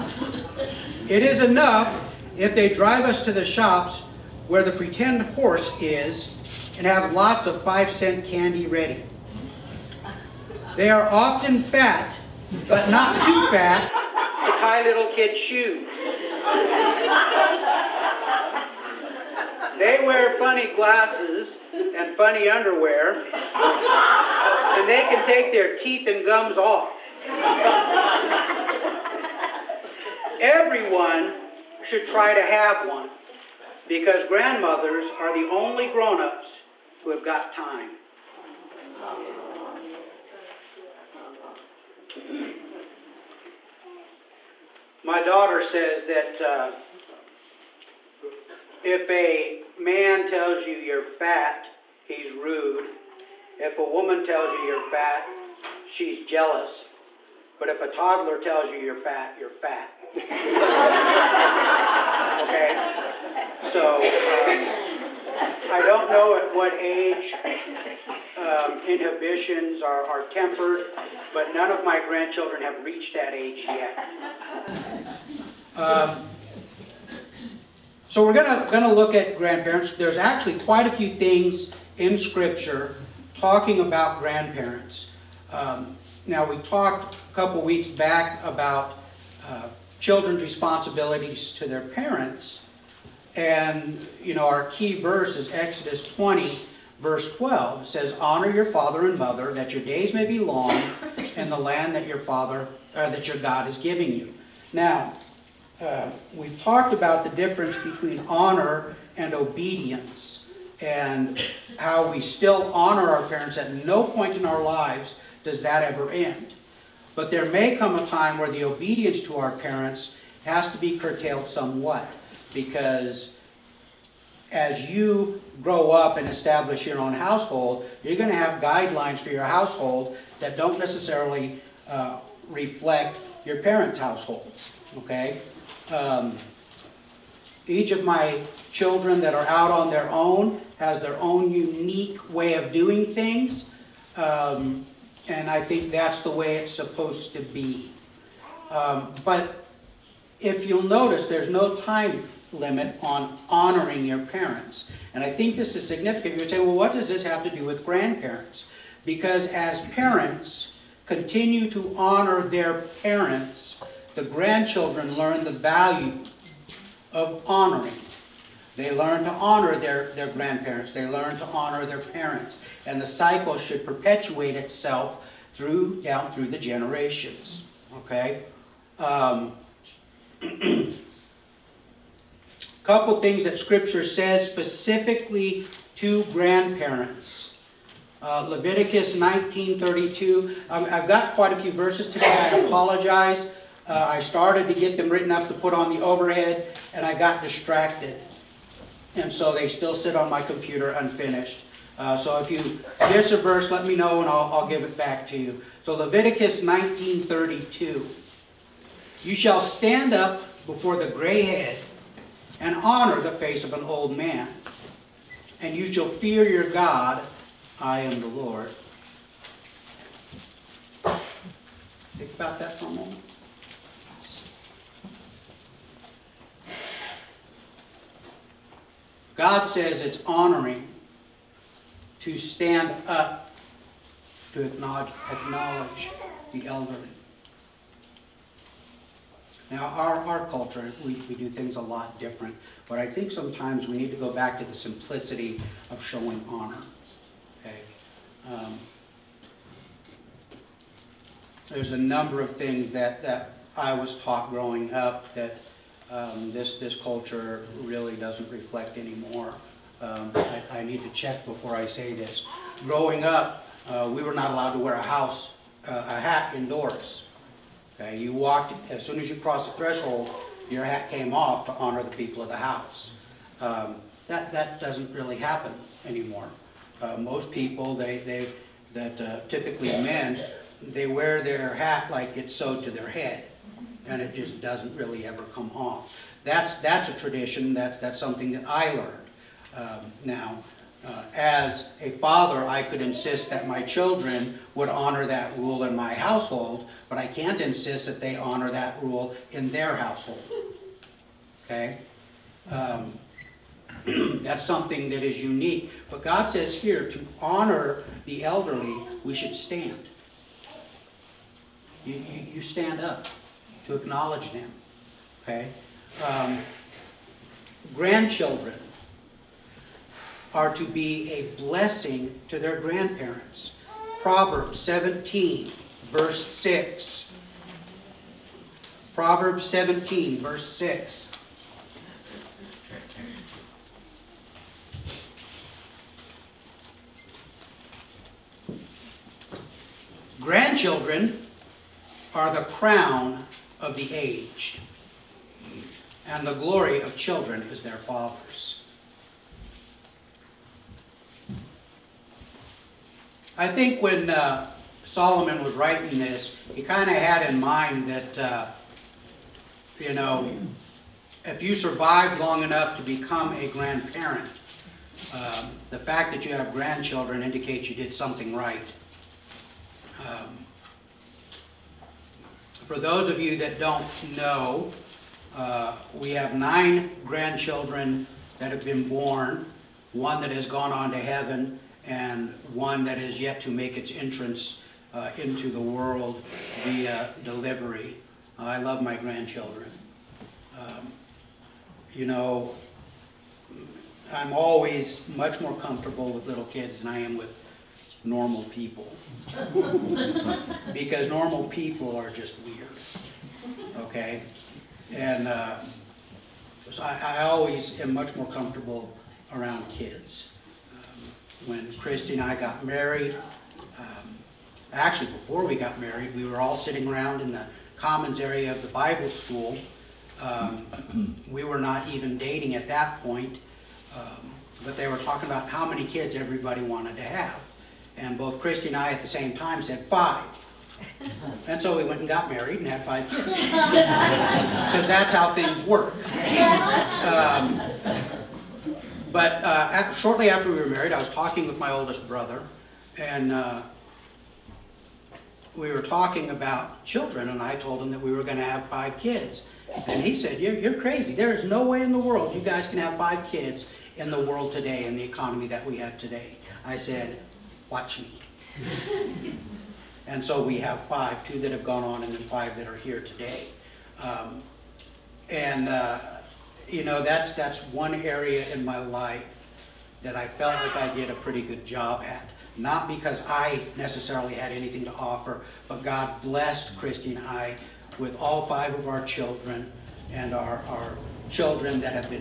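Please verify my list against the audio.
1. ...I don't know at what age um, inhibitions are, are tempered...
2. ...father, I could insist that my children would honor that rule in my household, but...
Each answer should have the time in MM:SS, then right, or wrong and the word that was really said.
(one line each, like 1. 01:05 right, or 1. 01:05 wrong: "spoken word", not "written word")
1. 01:05 right
2. 04:52 right.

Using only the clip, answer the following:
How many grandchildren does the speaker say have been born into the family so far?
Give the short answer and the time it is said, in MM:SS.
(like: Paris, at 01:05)
9, at 06:16.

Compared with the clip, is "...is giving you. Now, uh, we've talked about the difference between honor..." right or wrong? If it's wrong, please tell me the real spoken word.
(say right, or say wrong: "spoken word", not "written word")
right.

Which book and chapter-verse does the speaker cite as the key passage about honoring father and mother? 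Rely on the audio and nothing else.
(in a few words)
Exodus 20:12.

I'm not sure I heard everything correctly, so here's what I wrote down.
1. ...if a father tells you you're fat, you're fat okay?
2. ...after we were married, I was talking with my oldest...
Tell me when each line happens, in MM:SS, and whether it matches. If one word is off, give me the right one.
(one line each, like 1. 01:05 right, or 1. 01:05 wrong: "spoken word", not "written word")
1. 00:57 wrong: "toddler", not "father"
2. 07:20 right.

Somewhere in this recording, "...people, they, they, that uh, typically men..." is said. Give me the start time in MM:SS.
04:37.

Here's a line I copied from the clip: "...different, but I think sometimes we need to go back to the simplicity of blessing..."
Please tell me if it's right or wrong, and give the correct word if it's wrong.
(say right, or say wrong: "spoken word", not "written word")
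wrong: "showing", not "blessing".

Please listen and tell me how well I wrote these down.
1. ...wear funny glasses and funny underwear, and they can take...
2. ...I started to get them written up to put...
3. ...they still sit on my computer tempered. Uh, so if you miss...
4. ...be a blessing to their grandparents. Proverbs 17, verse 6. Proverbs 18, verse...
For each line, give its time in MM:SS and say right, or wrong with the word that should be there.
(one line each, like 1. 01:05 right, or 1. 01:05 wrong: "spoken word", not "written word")
1. 00:20 right
2. 03:14 right
3. 03:19 wrong: "unfinished", not "tempered"
4. 05:20 wrong: "17", not "18".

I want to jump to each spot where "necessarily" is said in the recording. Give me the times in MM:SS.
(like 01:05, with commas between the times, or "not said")
02:10, 07:53.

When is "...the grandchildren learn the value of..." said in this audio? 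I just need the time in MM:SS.
02:44.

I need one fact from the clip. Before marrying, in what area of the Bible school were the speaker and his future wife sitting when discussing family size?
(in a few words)
commons area.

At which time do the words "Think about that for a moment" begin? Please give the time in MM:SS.
03:42.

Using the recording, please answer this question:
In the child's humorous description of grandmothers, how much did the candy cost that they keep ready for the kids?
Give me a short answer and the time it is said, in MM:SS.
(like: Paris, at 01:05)
5 cents, at 00:07.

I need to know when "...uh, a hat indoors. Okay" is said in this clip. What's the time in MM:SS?
04:25.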